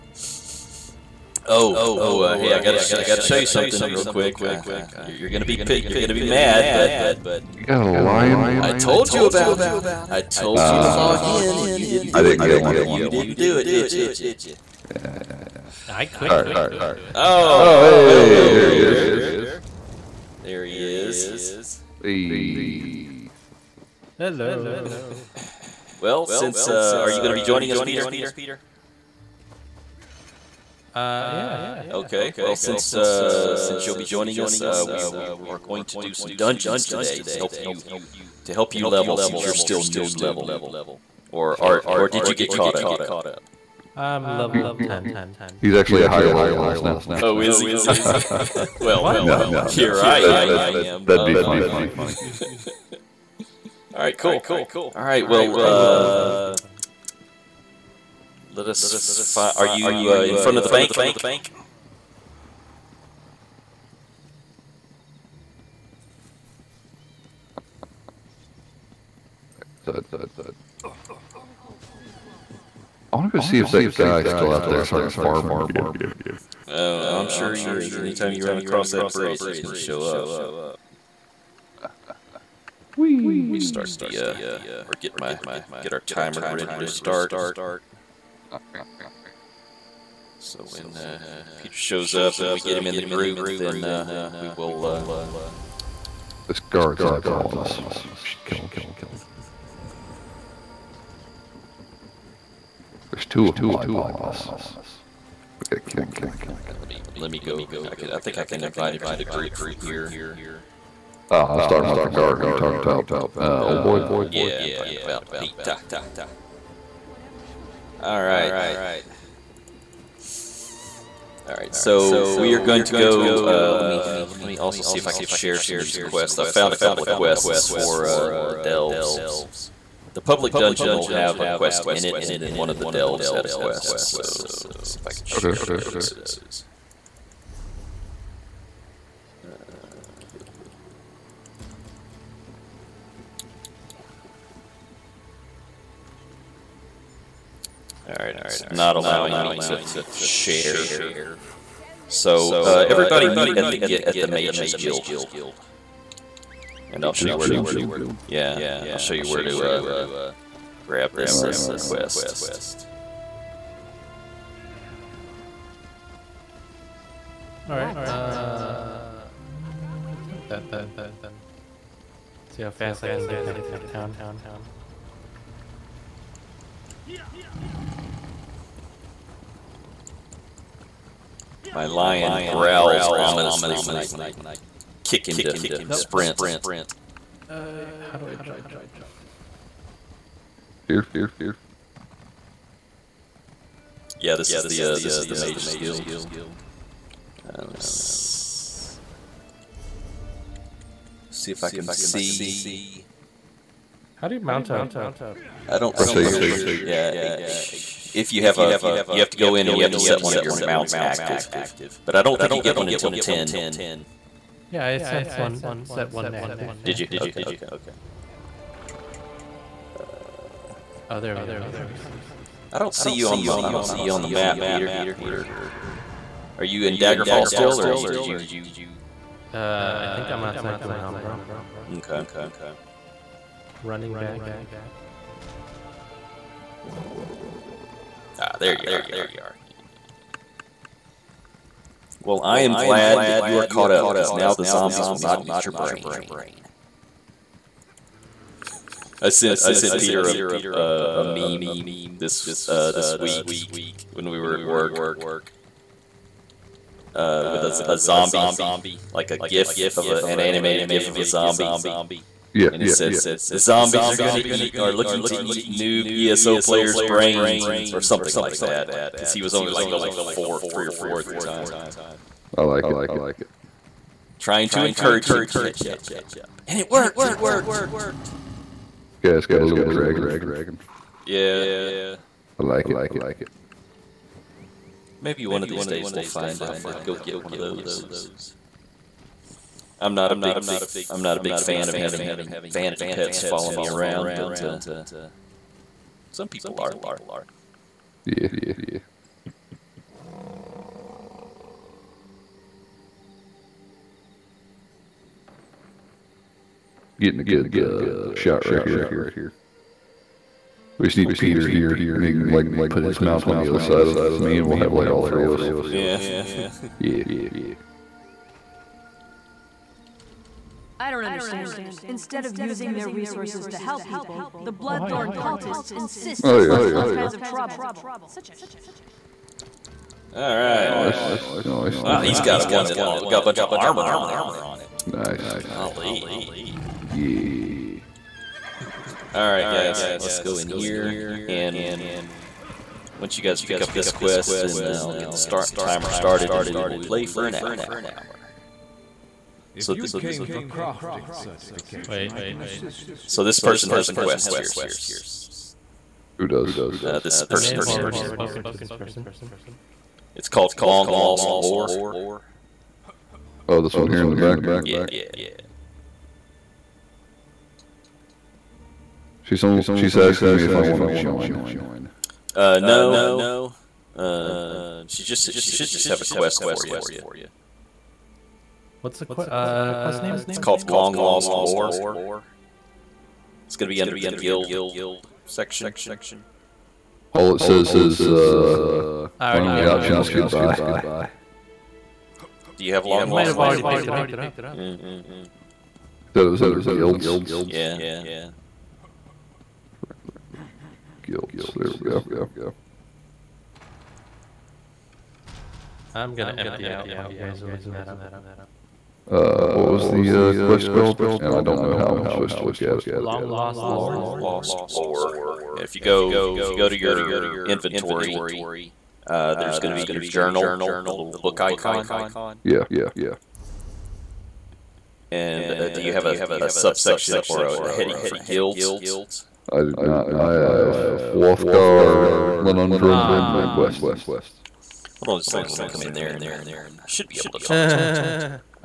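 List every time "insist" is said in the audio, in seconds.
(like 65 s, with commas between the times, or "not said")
325 s.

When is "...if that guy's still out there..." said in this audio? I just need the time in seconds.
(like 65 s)
73 s.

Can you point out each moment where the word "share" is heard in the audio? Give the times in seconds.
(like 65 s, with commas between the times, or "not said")
125 s, 135 s, 150 s.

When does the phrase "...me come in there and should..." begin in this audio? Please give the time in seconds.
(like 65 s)
435 s.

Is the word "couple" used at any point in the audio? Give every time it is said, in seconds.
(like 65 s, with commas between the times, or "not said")
126 s.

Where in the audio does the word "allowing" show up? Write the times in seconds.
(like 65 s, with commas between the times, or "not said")
148 s.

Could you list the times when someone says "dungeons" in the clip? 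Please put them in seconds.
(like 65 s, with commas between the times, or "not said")
36 s, 130 s.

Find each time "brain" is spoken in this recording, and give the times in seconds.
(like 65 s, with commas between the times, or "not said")
245 s, 267 s.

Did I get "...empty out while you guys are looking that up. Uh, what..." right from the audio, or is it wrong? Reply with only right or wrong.
right.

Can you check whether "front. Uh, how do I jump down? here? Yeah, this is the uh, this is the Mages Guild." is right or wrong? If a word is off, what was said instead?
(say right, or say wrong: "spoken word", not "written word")
wrong: "sprint", not "front".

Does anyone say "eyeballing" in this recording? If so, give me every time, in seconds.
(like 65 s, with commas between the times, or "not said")
97 s, 103 s.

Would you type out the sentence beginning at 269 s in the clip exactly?
Because he was only like level four, three or four at the time.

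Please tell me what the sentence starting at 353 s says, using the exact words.
So this person has a quest here, so just Who does?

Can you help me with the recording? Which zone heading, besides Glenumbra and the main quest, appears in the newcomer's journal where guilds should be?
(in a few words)
Wrothgar.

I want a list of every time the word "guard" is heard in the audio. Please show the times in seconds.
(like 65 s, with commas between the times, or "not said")
96 s, 112 s.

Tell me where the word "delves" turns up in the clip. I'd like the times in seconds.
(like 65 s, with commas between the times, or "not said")
128 s, 132 s.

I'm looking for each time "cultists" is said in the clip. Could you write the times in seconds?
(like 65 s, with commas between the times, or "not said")
325 s.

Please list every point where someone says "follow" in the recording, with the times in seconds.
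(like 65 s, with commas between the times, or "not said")
293 s.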